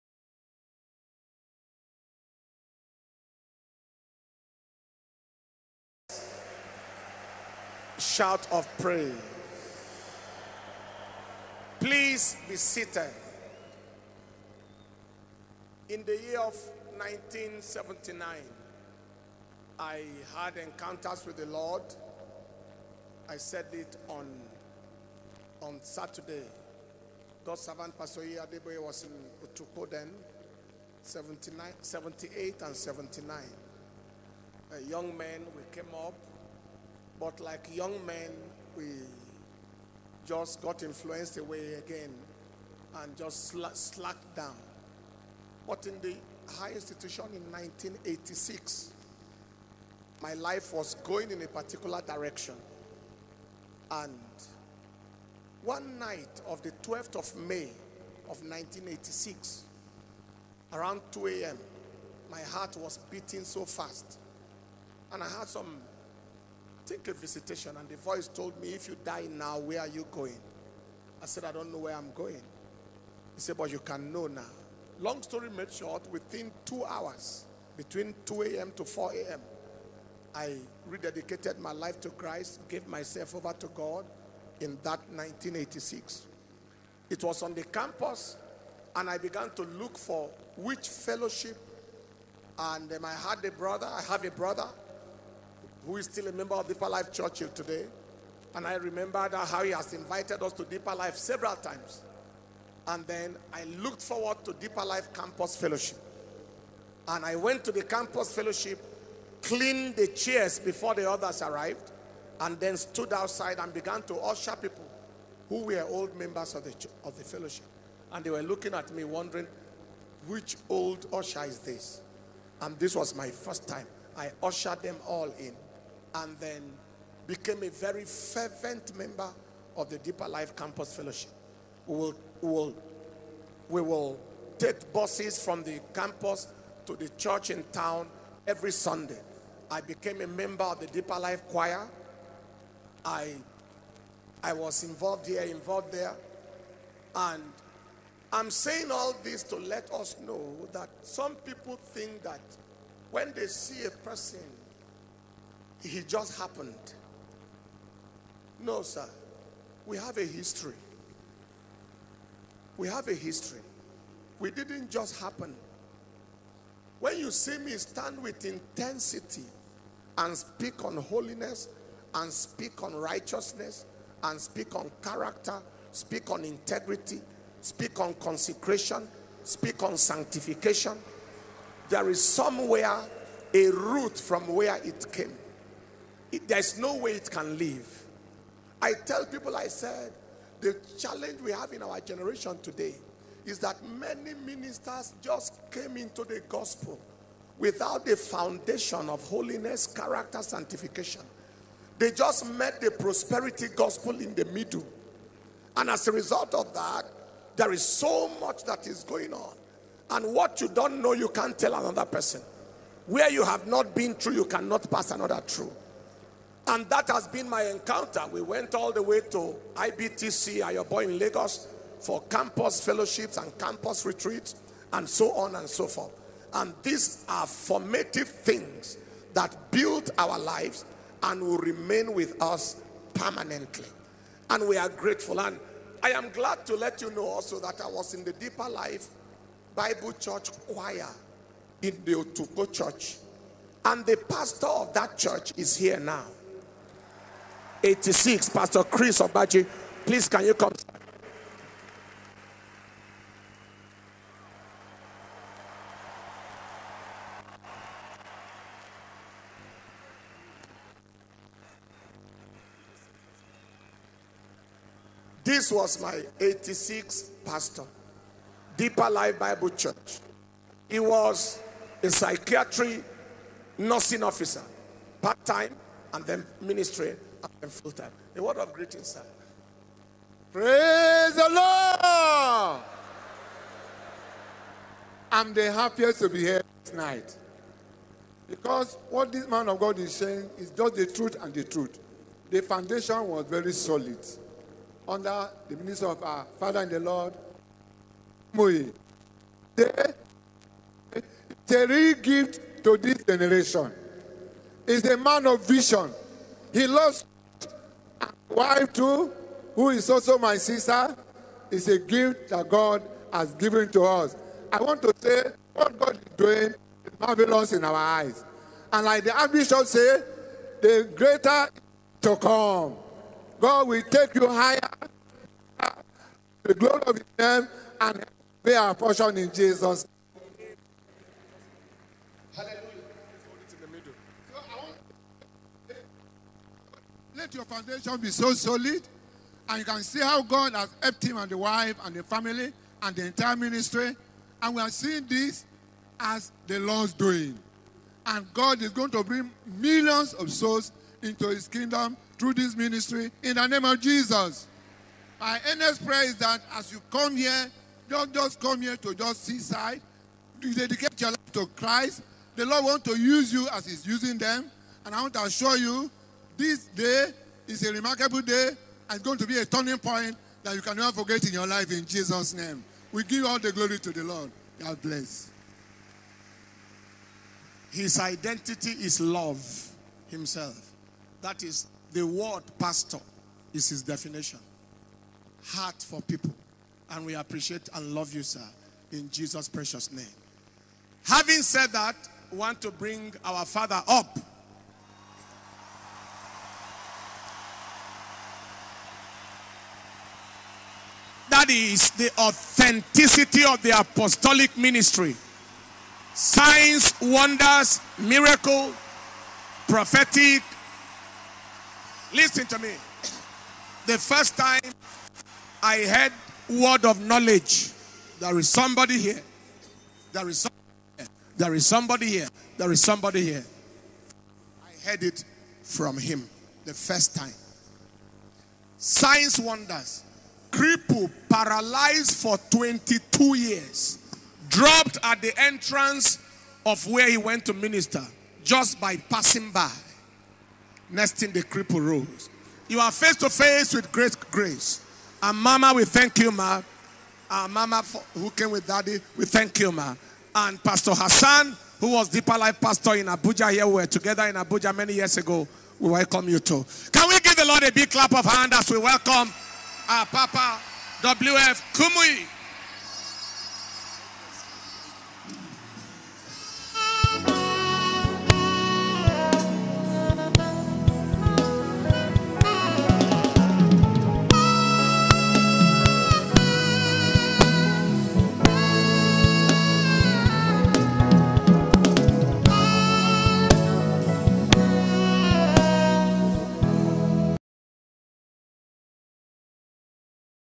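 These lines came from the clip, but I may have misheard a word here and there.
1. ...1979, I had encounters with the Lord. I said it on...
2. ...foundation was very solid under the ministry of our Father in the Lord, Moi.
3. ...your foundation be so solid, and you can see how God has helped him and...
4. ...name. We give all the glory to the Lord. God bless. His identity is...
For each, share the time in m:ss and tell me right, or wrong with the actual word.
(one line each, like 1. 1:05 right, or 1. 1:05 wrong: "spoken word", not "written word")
1. 0:16 right
2. 4:52 right
3. 5:37 right
4. 6:12 right.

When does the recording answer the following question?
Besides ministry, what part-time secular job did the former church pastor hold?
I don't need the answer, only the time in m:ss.
4:32.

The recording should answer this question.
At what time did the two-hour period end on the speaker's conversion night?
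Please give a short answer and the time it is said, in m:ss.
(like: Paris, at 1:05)
4 a.m., at 1:18.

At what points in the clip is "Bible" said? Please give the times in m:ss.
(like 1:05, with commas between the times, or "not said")
3:59, 4:29.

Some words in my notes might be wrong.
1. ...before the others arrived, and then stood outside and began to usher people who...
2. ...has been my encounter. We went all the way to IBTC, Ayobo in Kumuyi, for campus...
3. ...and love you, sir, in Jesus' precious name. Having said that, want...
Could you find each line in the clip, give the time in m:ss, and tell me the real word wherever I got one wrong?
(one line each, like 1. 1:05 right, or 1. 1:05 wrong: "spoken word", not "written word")
1. 1:50 right
2. 3:37 wrong: "Lagos", not "Kumuyi"
3. 6:27 right.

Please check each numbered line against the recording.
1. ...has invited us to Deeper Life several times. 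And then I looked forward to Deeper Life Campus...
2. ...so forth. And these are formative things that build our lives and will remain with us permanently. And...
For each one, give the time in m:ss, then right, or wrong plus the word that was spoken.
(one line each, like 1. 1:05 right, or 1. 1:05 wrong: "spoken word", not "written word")
1. 1:39 right
2. 3:45 right.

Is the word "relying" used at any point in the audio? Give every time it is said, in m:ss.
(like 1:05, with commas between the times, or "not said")
not said.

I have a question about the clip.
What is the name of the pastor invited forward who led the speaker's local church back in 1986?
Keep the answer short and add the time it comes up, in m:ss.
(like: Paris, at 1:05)
Chris Obaje, at 4:08.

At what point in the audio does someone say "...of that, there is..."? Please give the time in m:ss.
3:26.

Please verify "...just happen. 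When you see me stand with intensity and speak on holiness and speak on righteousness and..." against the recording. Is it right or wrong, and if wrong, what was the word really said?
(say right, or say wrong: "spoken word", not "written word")
right.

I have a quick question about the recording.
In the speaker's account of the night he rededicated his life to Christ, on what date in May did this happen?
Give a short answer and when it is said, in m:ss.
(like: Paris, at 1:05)
12th of May, at 0:56.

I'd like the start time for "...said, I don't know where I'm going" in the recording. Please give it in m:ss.
1:11.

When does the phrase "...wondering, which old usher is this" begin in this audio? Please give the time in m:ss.
1:59.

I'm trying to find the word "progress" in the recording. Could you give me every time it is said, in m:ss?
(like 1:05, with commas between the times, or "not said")
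not said.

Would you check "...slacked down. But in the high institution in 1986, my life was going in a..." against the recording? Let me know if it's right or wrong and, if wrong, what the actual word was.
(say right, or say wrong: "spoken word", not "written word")
right.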